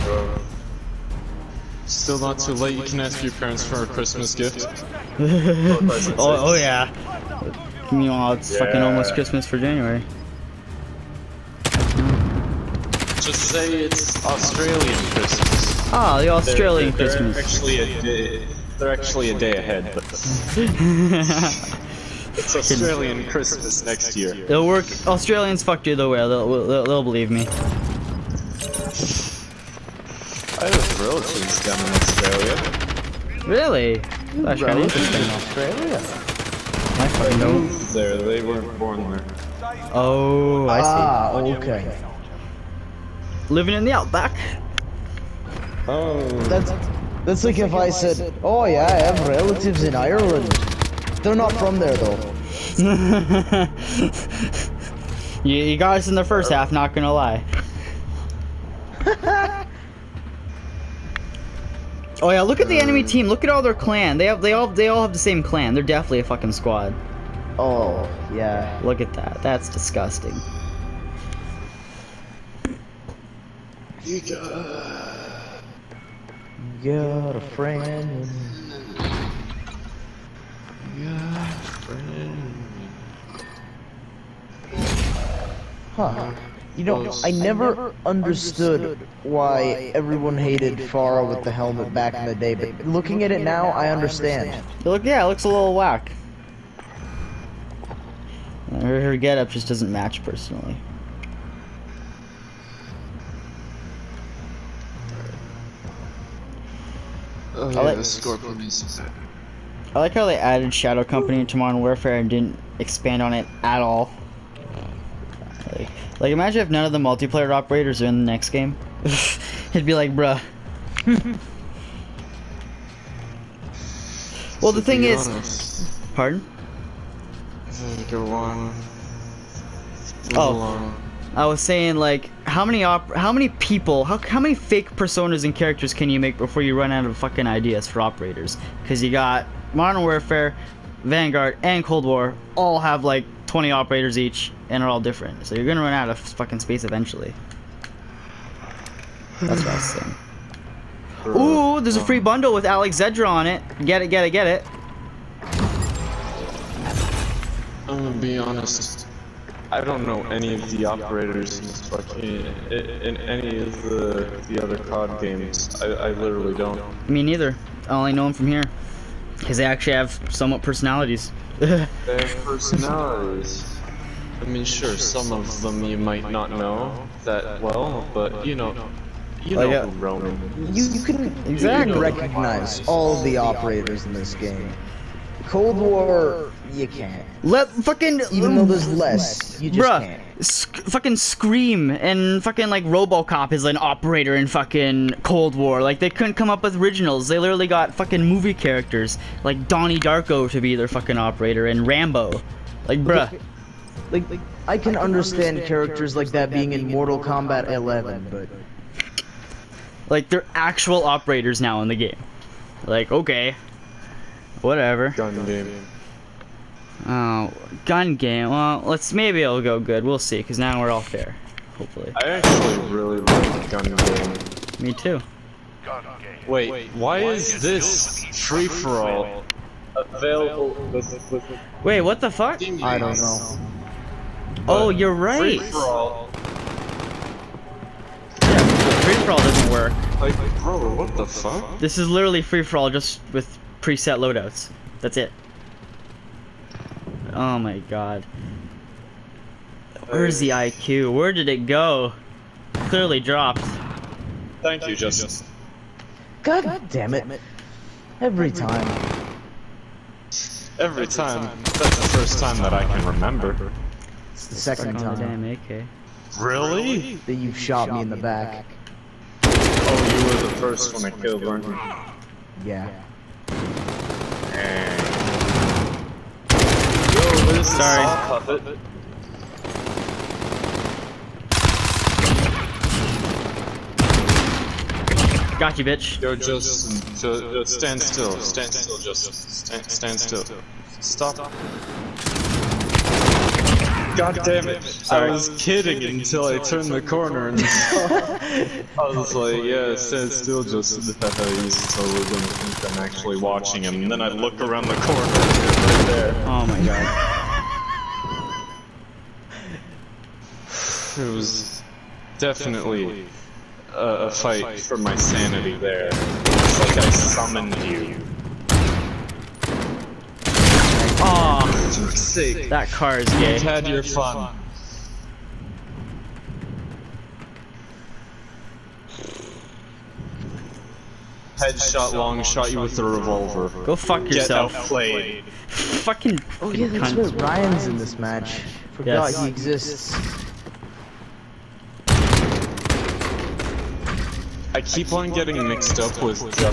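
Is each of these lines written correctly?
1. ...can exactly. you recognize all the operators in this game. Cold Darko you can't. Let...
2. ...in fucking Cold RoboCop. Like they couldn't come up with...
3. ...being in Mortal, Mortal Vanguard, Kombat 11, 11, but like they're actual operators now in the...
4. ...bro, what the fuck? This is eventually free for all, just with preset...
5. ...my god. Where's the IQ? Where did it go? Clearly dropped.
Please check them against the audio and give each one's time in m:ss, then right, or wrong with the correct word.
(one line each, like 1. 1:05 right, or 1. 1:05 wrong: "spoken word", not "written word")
1. 3:01 wrong: "War", not "Darko"
2. 3:14 wrong: "War", not "RoboCop"
3. 3:26 wrong: "Kombat", not "Vanguard"
4. 4:00 wrong: "literally", not "eventually"
5. 4:07 right.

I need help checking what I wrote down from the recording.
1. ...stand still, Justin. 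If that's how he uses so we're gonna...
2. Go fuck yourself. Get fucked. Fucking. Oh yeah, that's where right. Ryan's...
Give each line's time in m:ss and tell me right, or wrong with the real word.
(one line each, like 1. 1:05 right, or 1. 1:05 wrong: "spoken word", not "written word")
1. 4:59 right
2. 5:33 wrong: "outplayed", not "fucked".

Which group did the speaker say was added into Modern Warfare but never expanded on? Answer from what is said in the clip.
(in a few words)
Shadow Company.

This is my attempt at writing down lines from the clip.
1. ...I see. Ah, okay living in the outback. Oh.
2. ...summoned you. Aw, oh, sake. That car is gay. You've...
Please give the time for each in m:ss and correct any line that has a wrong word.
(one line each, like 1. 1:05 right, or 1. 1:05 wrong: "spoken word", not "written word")
1. 0:40 right
2. 5:17 right.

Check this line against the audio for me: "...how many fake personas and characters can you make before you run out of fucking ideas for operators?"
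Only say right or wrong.
right.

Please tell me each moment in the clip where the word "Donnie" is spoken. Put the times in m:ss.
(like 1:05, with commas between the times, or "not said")
3:19.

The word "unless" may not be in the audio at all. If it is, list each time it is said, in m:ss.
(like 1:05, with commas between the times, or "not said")
not said.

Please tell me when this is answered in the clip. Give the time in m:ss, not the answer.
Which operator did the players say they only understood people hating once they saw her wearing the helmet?
1:30.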